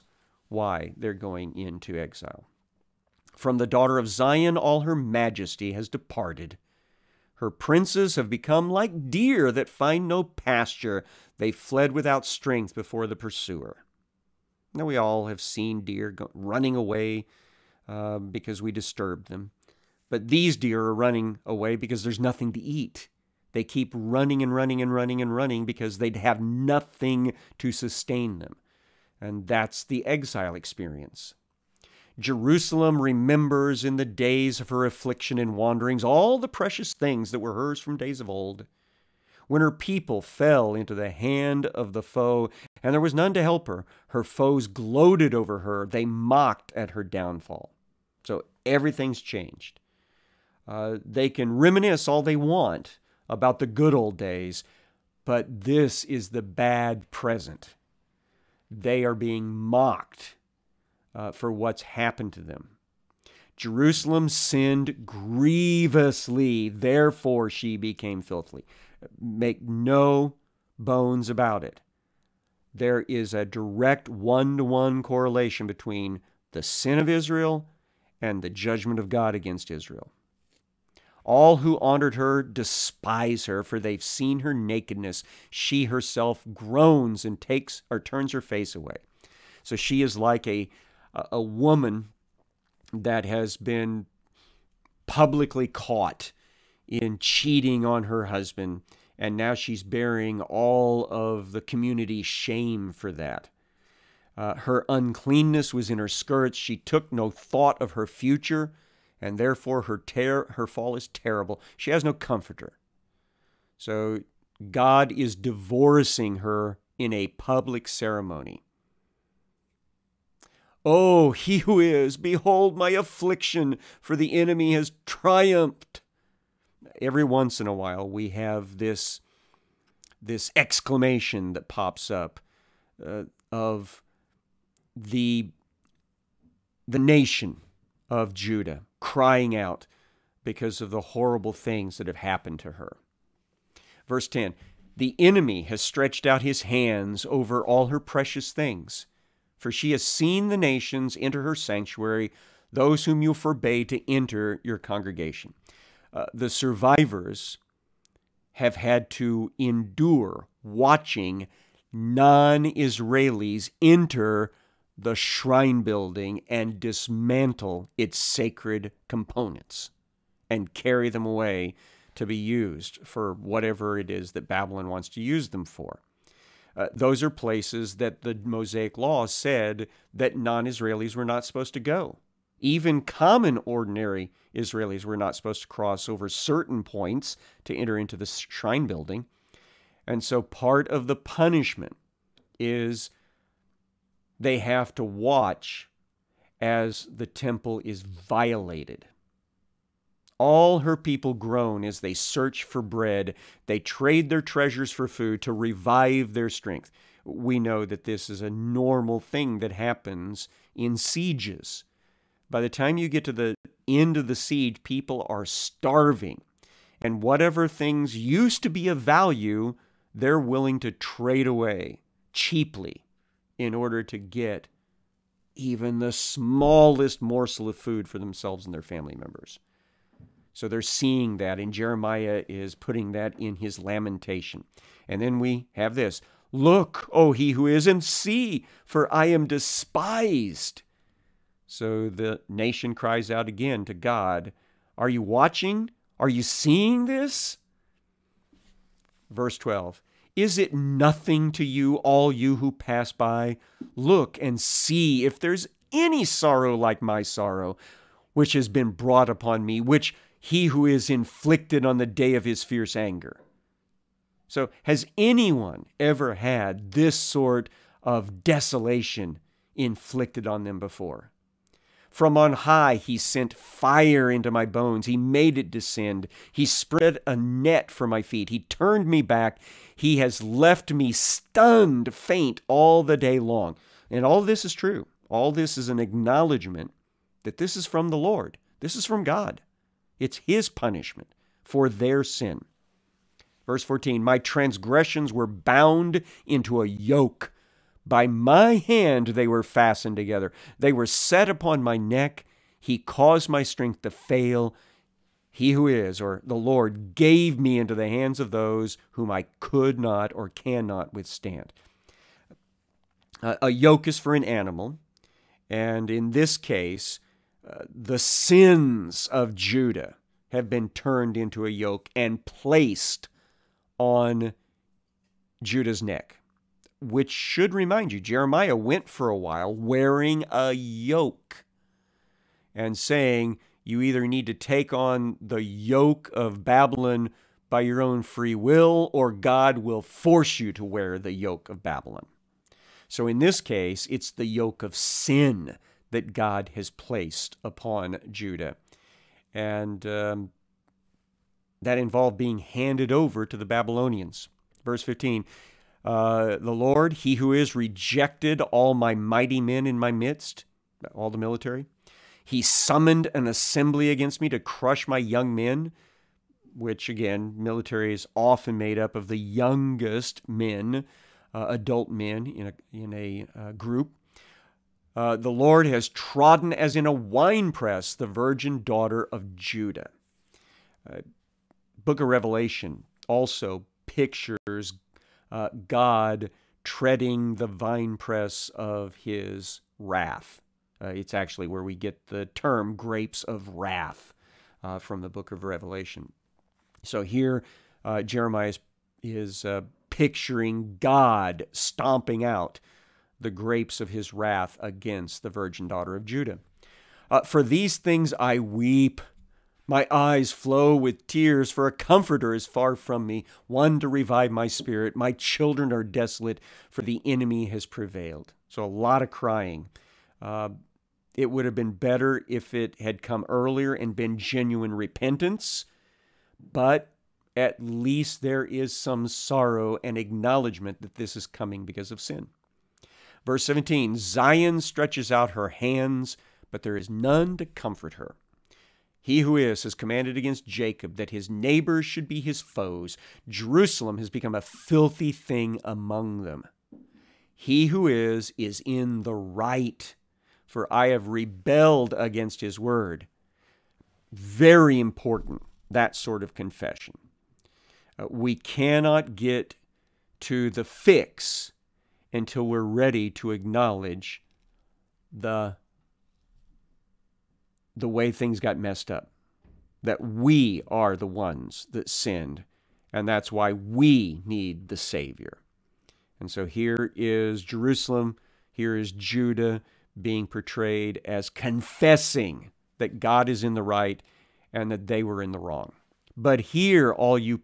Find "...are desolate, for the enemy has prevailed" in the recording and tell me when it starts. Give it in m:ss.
6:55.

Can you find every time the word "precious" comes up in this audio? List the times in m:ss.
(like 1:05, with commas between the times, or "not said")
0:36, 2:27.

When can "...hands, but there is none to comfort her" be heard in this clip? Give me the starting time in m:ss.
7:15.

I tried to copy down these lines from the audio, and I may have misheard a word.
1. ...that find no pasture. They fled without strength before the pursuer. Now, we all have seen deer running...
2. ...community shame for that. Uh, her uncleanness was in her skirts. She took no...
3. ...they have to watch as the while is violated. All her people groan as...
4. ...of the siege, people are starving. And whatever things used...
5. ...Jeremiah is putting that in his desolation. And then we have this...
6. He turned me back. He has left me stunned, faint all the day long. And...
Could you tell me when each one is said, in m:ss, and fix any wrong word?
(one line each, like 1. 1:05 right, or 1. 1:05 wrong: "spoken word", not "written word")
1. 0:09 right
2. 1:41 right
3. 3:14 wrong: "temple", not "while"
4. 3:34 right
5. 3:51 wrong: "lamentation", not "desolation"
6. 4:38 right.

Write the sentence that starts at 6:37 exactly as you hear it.
So here, Jeremiah is, is picturing God stomping out the grapes of his wrath against the virgin daughter of Judah.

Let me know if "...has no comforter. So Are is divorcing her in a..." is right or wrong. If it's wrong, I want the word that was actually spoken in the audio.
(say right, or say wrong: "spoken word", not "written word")
wrong: "God", not "Are".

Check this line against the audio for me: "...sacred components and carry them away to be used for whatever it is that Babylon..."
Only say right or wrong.
right.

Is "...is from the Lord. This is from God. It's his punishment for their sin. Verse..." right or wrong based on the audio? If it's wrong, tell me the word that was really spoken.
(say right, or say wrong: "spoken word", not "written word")
right.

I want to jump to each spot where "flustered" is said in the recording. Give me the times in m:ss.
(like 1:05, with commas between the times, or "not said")
not said.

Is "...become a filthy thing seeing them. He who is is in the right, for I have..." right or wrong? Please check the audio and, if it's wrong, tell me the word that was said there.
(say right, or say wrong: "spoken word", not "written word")
wrong: "among", not "seeing".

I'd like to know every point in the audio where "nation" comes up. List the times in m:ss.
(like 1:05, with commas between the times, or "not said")
2:16, 2:30, 4:02.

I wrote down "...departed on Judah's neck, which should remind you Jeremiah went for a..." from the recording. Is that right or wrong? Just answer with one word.
wrong.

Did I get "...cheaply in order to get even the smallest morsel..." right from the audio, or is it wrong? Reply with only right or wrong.
right.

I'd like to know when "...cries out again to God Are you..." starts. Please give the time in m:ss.
4:02.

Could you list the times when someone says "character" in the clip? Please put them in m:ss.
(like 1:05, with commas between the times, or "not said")
not said.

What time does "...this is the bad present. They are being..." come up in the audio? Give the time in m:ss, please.
0:55.